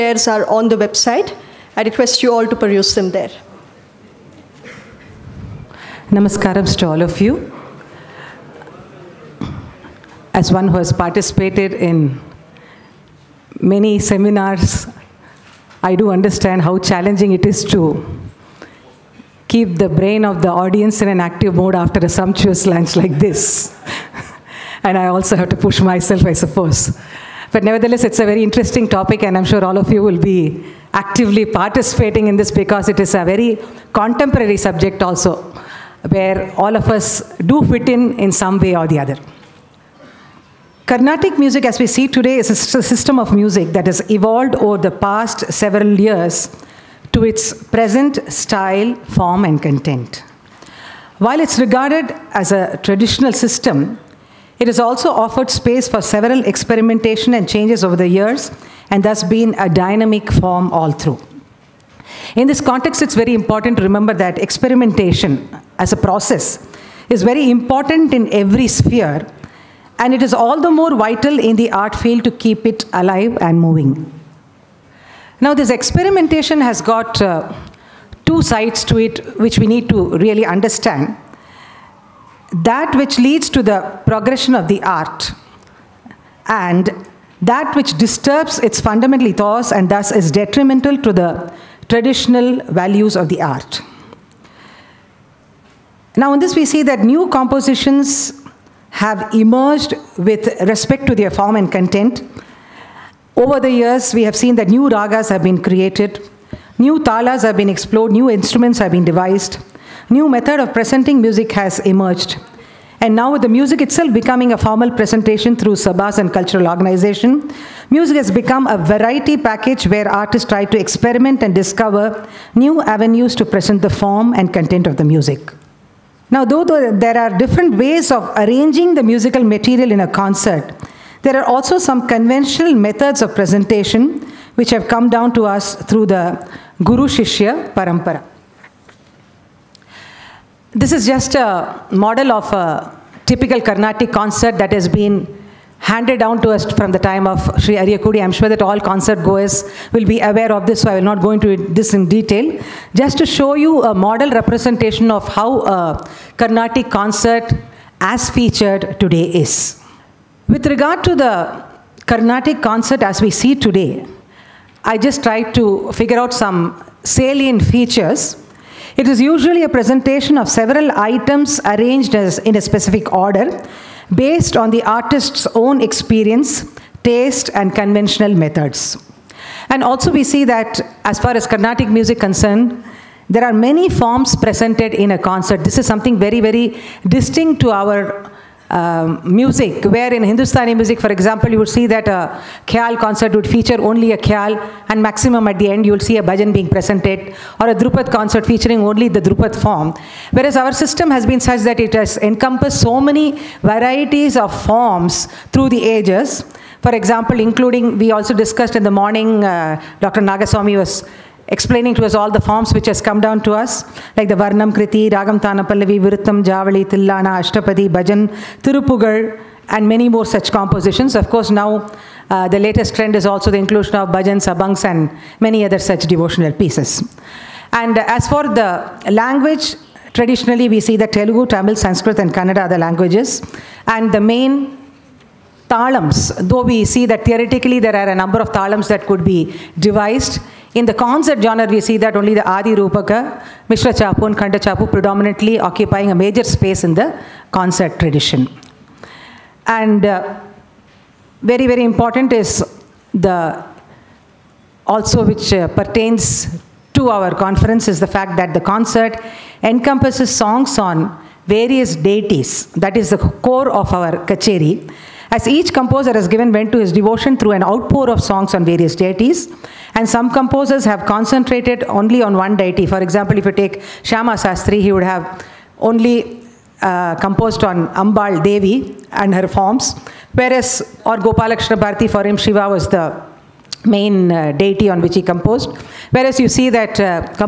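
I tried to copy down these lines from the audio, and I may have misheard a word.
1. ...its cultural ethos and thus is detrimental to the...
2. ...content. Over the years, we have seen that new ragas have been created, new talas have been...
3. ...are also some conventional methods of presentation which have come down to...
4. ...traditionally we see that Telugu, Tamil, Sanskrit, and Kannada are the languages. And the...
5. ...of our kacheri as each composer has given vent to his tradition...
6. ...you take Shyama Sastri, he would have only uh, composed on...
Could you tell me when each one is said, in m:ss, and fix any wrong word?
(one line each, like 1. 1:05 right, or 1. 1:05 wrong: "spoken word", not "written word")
1. 1:28 wrong: "fundamental", not "cultural"
2. 1:41 right
3. 2:11 right
4. 3:50 right
5. 4:23 wrong: "devotion", not "tradition"
6. 4:33 right.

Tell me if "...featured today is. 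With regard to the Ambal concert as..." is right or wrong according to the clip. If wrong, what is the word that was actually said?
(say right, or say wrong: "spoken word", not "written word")
wrong: "Carnatic", not "Ambal".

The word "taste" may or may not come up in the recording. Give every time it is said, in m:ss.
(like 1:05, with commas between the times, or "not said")
2:57.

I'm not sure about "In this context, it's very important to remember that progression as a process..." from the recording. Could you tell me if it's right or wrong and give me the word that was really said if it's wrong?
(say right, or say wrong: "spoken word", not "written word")
wrong: "experimentation", not "progression".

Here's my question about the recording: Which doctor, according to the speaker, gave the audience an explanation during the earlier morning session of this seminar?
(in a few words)
Dr. 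Nagaswamy.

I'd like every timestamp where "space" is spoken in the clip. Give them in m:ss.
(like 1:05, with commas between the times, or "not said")
0:55, 4:06.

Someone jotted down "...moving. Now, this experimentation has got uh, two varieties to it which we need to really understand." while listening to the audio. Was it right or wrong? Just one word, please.
wrong.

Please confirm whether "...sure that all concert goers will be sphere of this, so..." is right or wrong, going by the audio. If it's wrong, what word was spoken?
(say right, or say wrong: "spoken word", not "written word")
wrong: "aware", not "sphere".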